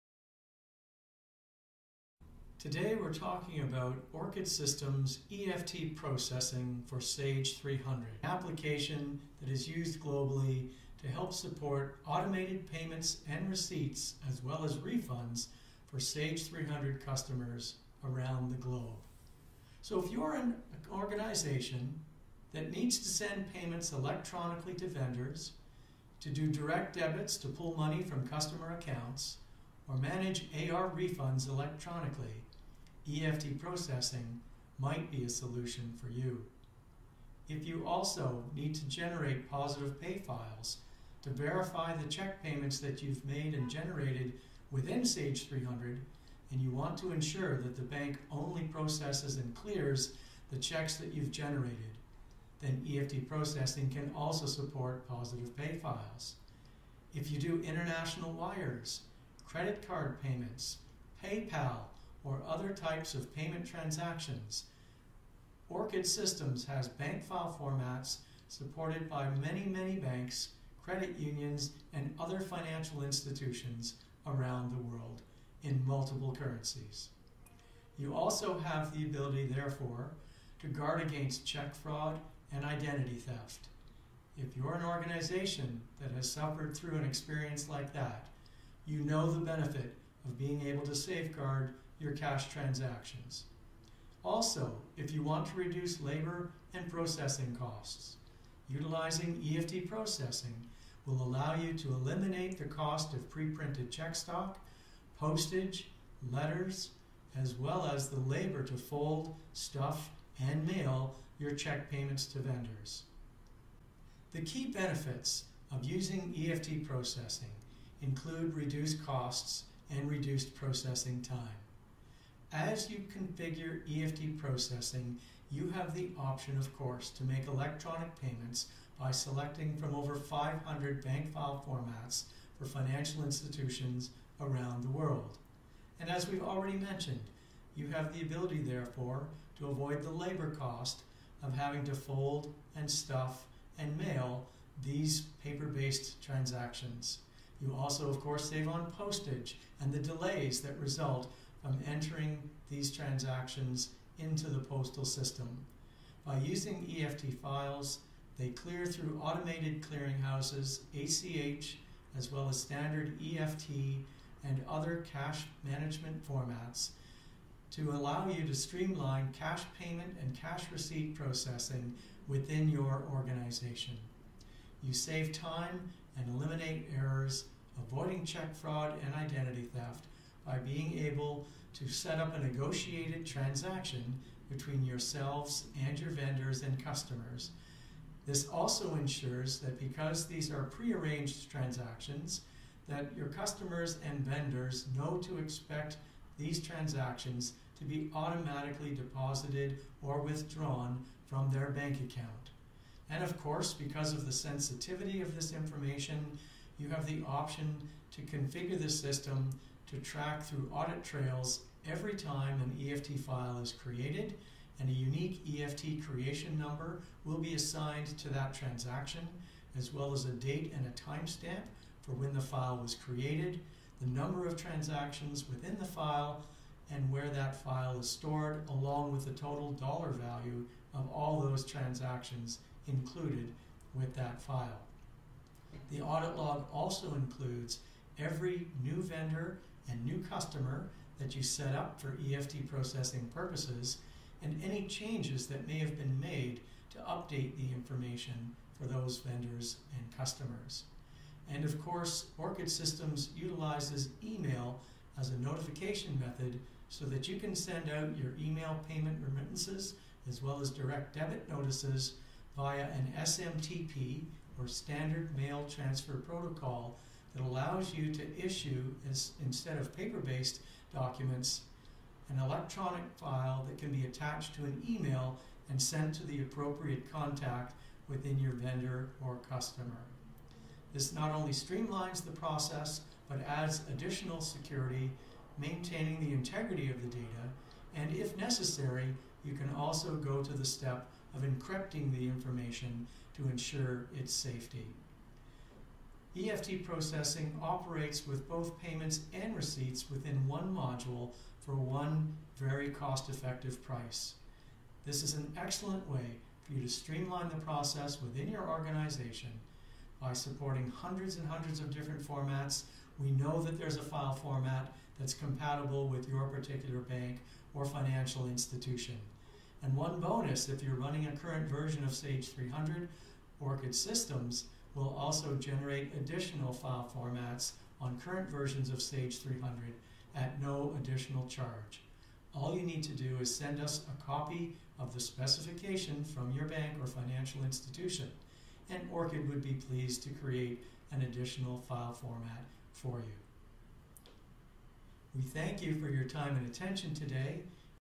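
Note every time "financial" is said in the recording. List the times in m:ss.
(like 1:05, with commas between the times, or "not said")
1:12, 2:12, 5:17, 5:37.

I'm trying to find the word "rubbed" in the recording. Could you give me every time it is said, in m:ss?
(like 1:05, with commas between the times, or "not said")
not said.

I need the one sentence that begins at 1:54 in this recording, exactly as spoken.
The key benefits of using EFT processing include reduced costs and reduced processing time.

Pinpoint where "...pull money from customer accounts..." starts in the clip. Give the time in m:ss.
0:27.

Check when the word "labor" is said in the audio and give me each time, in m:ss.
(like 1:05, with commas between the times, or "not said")
1:36, 1:48, 2:20.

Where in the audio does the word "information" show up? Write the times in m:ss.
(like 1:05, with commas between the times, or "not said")
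3:25, 4:07, 4:52.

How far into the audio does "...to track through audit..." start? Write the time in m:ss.
3:29.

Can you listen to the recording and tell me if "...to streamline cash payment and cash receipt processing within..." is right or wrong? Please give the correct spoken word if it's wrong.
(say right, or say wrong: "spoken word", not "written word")
right.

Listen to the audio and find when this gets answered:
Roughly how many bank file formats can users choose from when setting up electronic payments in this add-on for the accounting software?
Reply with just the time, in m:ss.
2:09.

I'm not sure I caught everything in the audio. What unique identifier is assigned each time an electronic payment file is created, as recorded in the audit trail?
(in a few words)
EFT creation number.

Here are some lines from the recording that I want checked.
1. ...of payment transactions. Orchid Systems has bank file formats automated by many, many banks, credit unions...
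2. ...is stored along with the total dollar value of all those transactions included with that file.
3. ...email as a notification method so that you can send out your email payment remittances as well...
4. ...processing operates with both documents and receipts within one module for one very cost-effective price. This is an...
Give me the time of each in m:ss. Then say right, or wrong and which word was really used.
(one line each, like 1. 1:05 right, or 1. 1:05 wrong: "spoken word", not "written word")
1. 1:03 wrong: "supported", not "automated"
2. 3:47 right
3. 4:14 right
4. 4:56 wrong: "payments", not "documents".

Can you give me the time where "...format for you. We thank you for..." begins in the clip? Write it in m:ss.
5:42.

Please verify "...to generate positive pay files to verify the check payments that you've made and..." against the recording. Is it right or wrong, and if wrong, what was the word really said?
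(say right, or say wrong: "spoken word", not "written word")
right.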